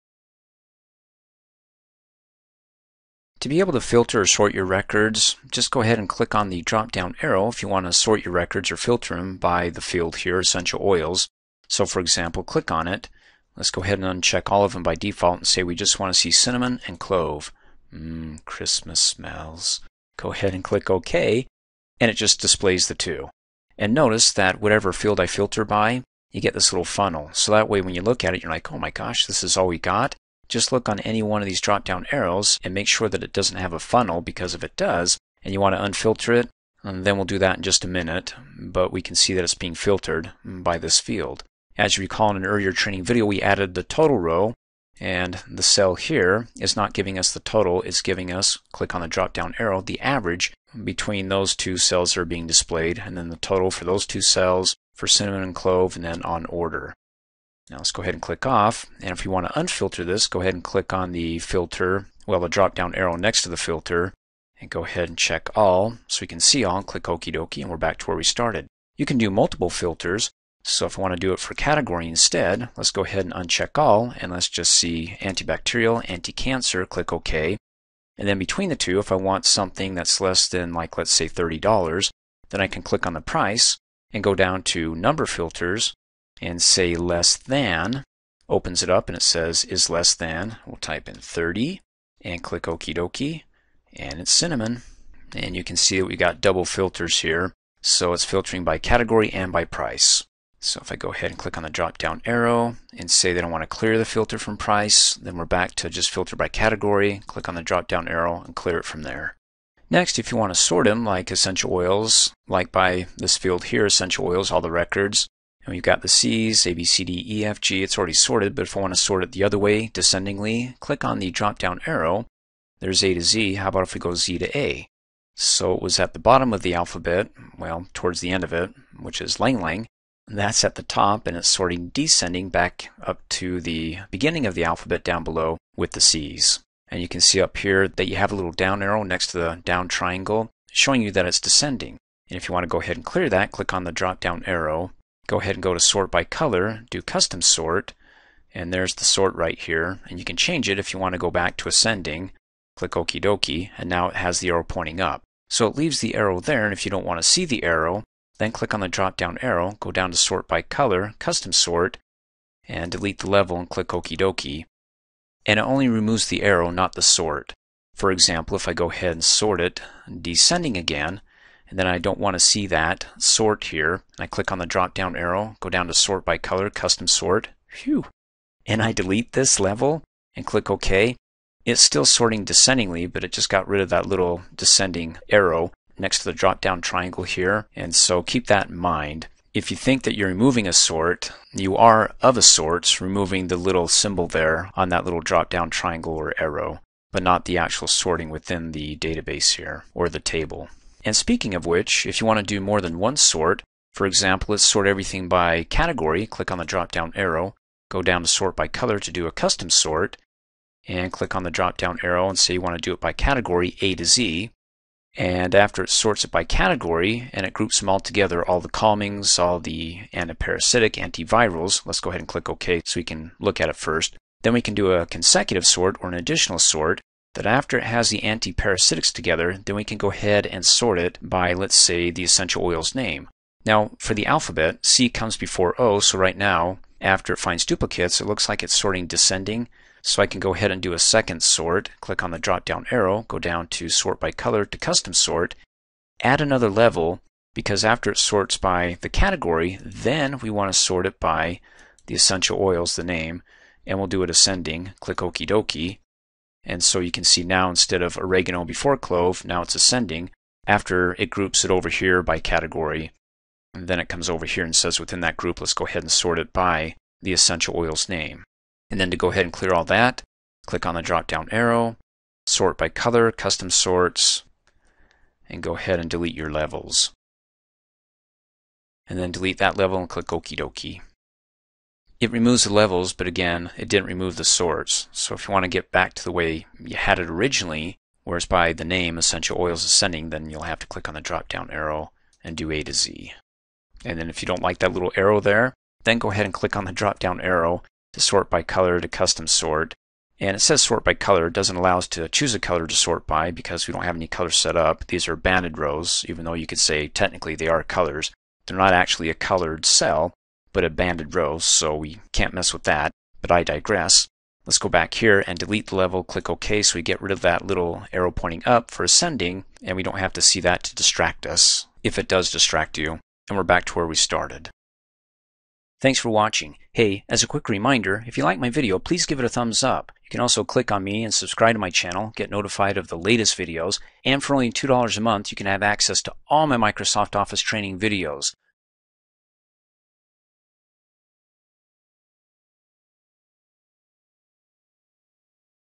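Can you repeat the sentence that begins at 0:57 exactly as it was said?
Now let's go ahead and click off.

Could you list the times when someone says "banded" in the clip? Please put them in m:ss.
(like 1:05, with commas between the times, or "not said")
5:05, 5:10.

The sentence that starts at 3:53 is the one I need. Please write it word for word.
Now, for the alphabet, C comes before O, so right now, after it finds duplicates, it looks like it's sorting descending.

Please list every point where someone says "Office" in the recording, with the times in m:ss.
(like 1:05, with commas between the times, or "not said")
5:37.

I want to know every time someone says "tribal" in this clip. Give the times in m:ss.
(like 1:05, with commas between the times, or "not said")
not said.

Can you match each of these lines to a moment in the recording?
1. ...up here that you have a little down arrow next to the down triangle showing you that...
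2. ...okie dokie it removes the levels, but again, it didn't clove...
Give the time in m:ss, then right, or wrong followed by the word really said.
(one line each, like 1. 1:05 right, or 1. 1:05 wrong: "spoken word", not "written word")
1. 2:17 right
2. 4:40 wrong: "remove", not "clove".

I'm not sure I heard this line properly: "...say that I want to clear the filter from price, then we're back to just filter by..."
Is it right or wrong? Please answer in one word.
right.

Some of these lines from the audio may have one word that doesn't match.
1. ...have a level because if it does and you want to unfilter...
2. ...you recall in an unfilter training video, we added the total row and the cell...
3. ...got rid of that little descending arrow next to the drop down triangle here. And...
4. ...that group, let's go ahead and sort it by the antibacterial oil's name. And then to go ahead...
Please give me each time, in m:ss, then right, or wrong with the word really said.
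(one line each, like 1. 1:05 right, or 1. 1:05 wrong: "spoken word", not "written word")
1. 0:33 wrong: "funnel", not "level"
2. 0:41 wrong: "earlier", not "unfilter"
3. 3:03 right
4. 4:25 wrong: "essential", not "antibacterial".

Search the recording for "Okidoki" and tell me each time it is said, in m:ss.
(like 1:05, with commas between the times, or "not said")
2:32, 2:43.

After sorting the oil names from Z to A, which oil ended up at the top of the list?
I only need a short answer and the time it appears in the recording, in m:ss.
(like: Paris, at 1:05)
Ylang Ylang, at 2:09.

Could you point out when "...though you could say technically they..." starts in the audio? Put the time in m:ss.
5:06.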